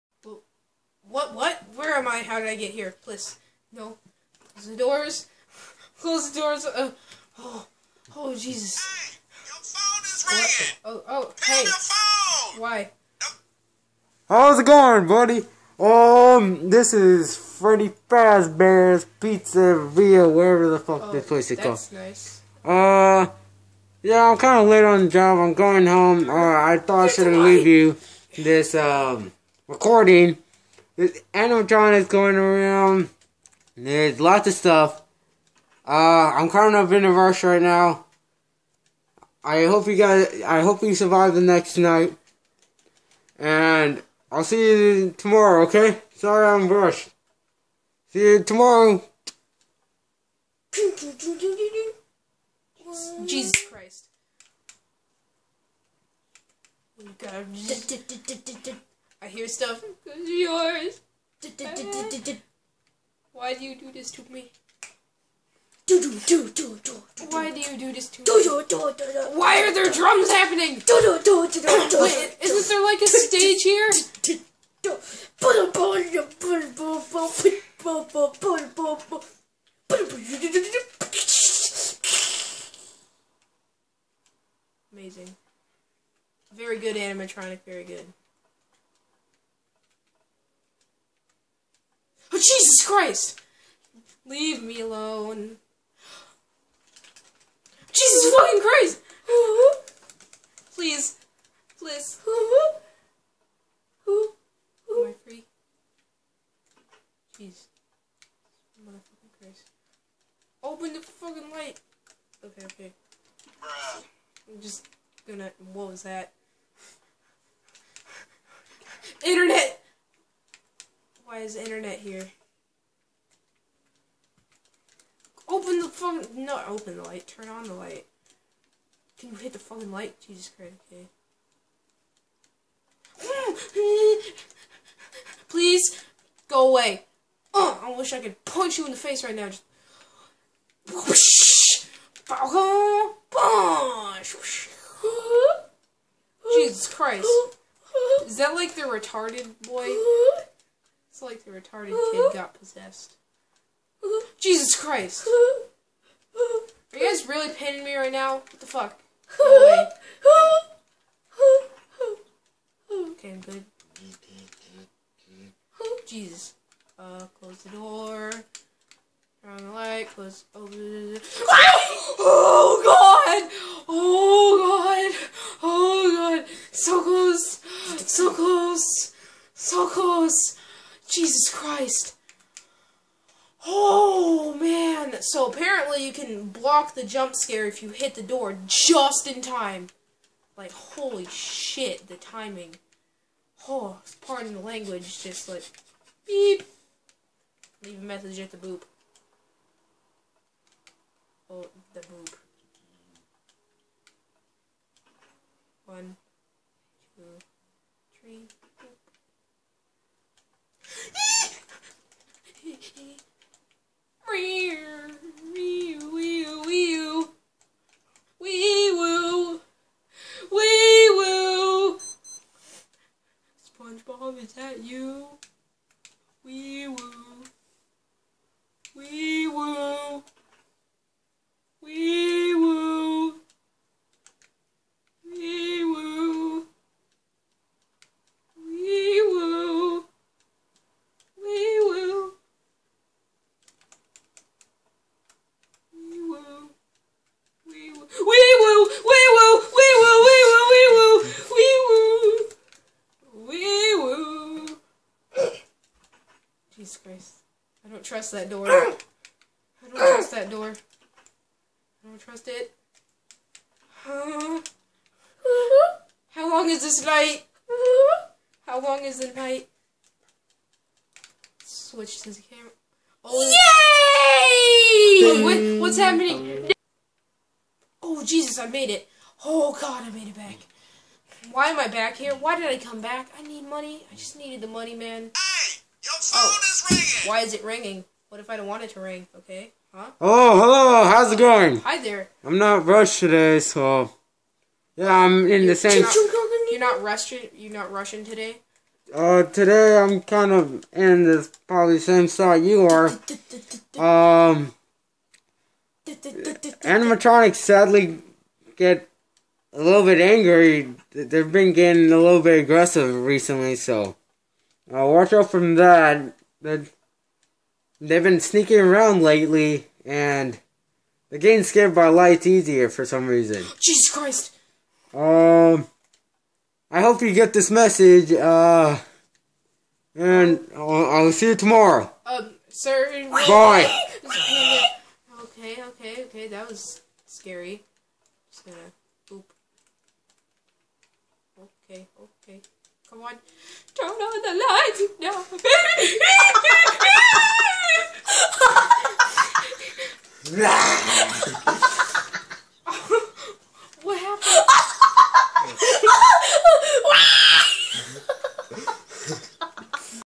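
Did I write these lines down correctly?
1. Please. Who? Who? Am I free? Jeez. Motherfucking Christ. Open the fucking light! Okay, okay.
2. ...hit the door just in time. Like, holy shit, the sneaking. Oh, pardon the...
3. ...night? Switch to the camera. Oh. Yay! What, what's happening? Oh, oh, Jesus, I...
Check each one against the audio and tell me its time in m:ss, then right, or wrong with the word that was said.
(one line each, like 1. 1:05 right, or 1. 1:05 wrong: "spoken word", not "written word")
1. 1:41 right
2. 3:07 wrong: "timing", not "sneaking"
3. 4:29 right.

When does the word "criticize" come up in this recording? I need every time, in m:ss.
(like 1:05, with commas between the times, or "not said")
not said.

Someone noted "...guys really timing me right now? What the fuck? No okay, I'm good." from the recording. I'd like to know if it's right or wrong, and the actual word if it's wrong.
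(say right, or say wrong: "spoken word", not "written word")
wrong: "pinning", not "timing".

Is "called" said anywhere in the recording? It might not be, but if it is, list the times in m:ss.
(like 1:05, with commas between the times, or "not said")
0:21.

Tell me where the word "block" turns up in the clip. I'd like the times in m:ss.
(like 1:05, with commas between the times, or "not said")
3:06.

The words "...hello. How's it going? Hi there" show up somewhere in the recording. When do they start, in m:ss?
4:50.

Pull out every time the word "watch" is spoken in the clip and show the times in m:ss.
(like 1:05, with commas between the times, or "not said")
5:15.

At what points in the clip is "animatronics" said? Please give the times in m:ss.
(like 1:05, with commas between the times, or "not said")
0:31, 1:26, 5:06.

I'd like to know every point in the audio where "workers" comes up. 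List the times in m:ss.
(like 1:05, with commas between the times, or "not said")
not said.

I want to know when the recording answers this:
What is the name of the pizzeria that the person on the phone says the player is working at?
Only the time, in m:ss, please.
0:17.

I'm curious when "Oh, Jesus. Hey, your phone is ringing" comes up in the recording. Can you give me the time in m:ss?
0:08.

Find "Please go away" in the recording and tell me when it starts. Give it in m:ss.
2:15.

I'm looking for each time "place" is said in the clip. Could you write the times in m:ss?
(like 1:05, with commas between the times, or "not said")
0:21.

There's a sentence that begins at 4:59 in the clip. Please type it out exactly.
Uh, today I'm kind of in this probably same spot you are.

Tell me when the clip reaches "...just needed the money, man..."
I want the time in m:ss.
4:44.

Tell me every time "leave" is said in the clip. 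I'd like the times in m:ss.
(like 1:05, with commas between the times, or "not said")
0:27, 1:34, 3:17.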